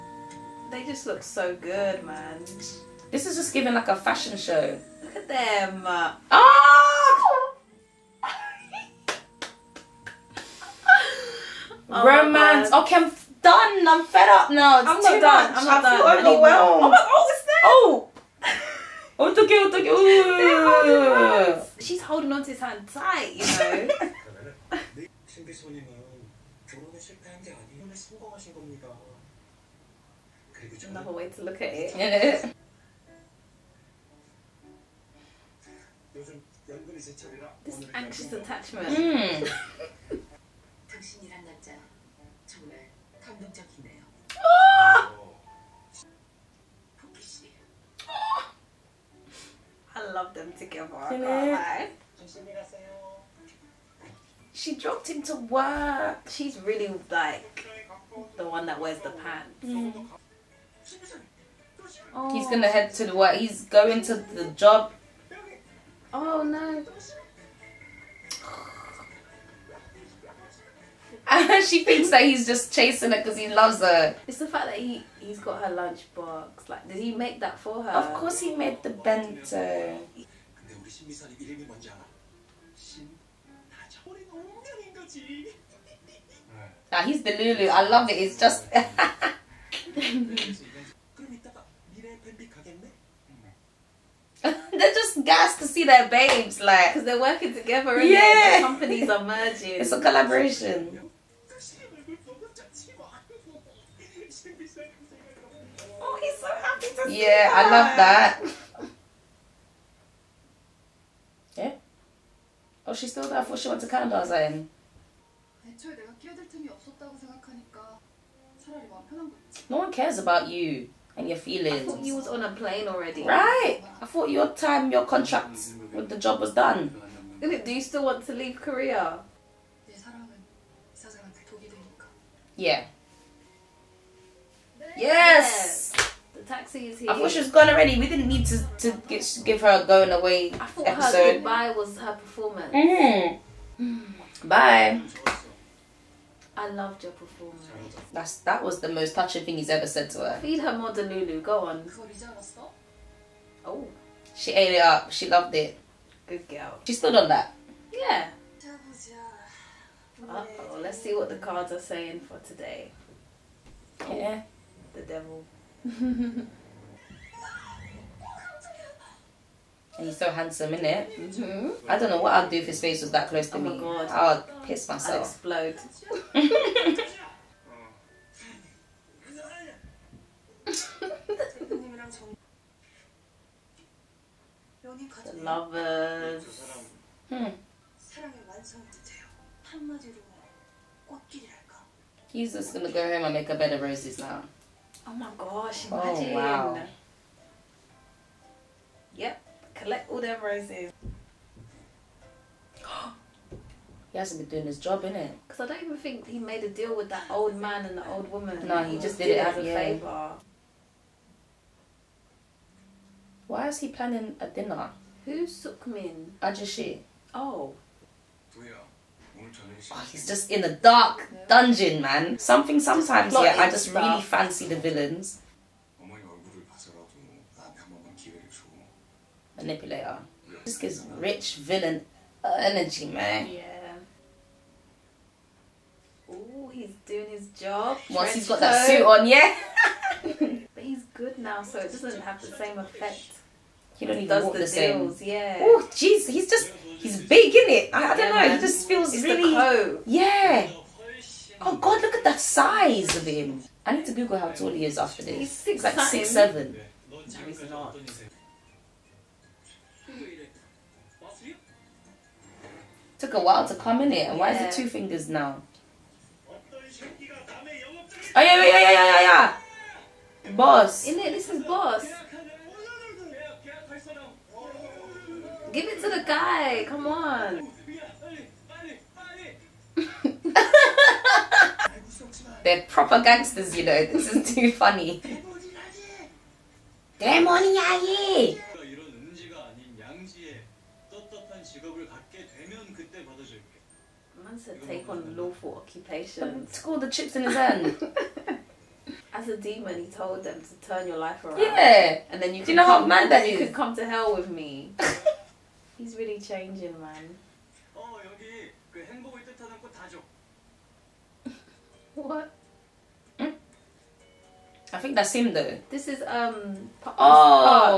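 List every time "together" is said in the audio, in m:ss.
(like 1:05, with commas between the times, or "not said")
0:50, 1:37.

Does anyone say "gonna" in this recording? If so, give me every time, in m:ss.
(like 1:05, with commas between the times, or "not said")
1:02, 3:12.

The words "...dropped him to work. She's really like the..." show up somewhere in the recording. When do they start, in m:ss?
0:54.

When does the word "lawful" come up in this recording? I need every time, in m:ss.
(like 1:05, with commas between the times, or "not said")
4:55.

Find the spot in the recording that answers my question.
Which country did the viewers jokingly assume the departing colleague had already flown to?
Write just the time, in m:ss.
1:53.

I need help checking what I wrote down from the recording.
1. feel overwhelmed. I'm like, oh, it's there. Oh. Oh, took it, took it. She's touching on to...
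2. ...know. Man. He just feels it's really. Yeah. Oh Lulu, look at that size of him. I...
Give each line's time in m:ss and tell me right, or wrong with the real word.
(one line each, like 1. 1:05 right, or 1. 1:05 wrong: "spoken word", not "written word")
1. 0:15 wrong: "holding", not "touching"
2. 4:08 wrong: "God", not "Lulu".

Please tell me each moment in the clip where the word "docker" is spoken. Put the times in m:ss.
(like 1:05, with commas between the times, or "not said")
not said.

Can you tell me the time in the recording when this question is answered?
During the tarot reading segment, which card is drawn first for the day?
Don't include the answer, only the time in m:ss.
2:44.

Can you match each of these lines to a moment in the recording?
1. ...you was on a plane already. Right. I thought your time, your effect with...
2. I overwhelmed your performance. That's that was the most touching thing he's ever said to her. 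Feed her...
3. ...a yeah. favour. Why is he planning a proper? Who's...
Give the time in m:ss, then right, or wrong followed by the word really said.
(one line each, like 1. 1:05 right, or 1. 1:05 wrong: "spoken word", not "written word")
1. 2:02 wrong: "contract", not "effect"
2. 2:26 wrong: "loved", not "overwhelmed"
3. 3:29 wrong: "dinner", not "proper".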